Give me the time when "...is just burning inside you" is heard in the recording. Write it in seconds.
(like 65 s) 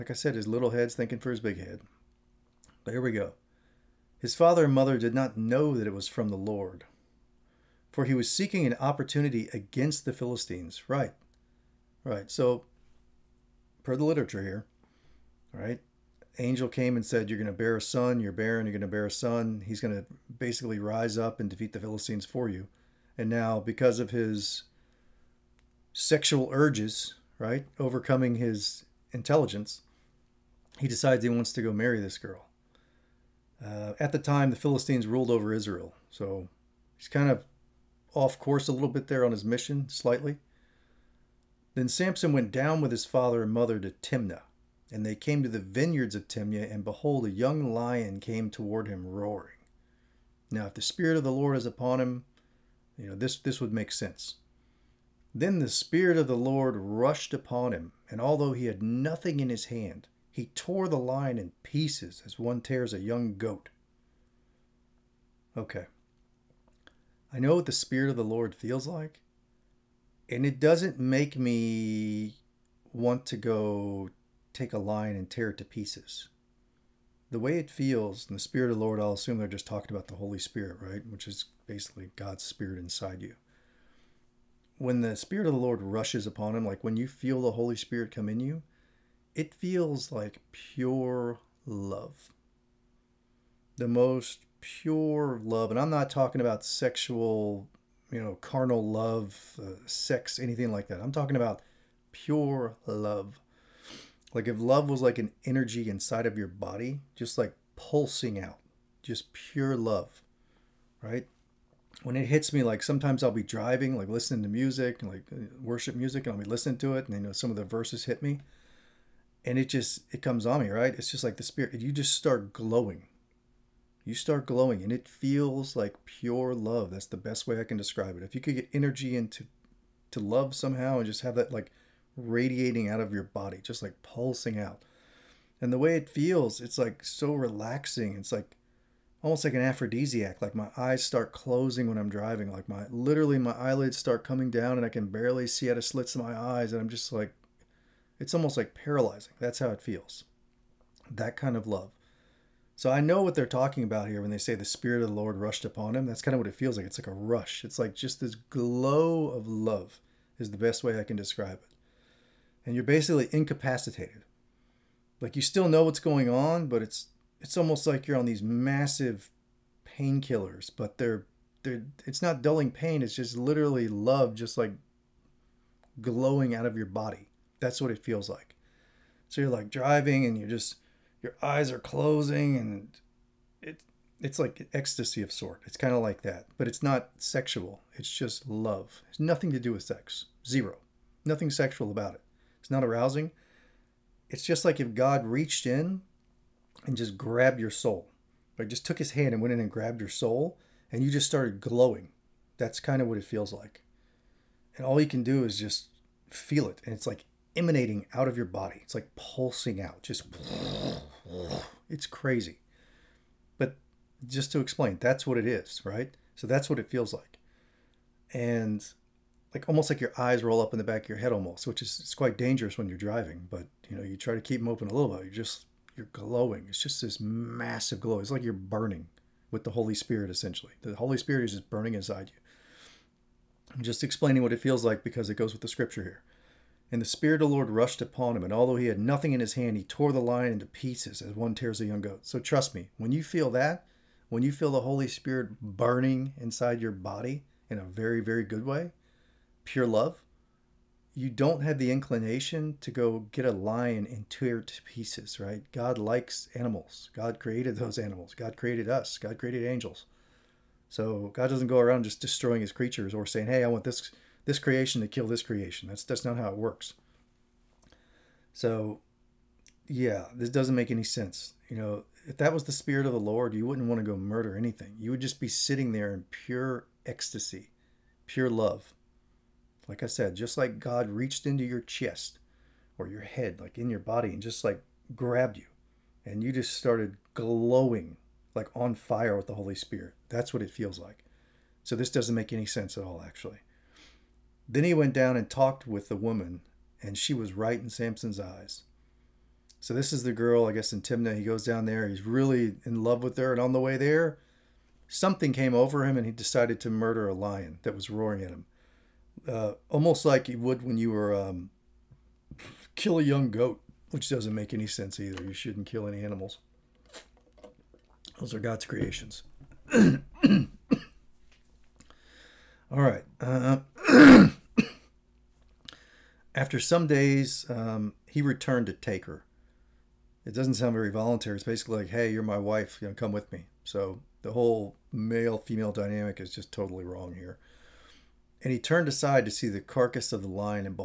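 231 s.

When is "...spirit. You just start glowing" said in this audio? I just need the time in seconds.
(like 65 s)
121 s.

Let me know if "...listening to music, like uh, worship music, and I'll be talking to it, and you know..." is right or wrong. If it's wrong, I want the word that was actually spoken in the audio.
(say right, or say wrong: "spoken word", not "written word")
wrong: "listening", not "talking".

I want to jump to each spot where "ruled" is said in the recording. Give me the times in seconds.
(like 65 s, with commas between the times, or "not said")
35 s.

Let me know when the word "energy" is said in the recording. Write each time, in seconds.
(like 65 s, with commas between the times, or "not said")
105 s, 128 s.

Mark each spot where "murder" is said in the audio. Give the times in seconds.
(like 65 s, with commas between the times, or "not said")
274 s, 306 s.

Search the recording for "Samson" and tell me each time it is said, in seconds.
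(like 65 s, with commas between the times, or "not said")
41 s, 297 s.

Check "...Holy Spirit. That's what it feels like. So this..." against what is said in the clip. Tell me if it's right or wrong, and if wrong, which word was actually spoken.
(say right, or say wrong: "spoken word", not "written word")
right.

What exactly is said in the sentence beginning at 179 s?
So you're like driving and you're just your eyes are closing and it it's like ecstasy of sort.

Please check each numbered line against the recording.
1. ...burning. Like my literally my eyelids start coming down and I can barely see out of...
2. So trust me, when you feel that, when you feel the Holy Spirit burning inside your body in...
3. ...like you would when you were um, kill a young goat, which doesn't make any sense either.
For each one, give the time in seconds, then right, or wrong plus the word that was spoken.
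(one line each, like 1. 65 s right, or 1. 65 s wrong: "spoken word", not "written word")
1. 142 s wrong: "driving", not "burning"
2. 242 s right
3. 310 s right.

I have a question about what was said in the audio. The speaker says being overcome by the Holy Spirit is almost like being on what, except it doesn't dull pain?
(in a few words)
massive painkillers.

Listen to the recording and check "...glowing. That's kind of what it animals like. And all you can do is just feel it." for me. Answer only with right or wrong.
wrong.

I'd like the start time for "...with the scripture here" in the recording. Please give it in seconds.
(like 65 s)
235 s.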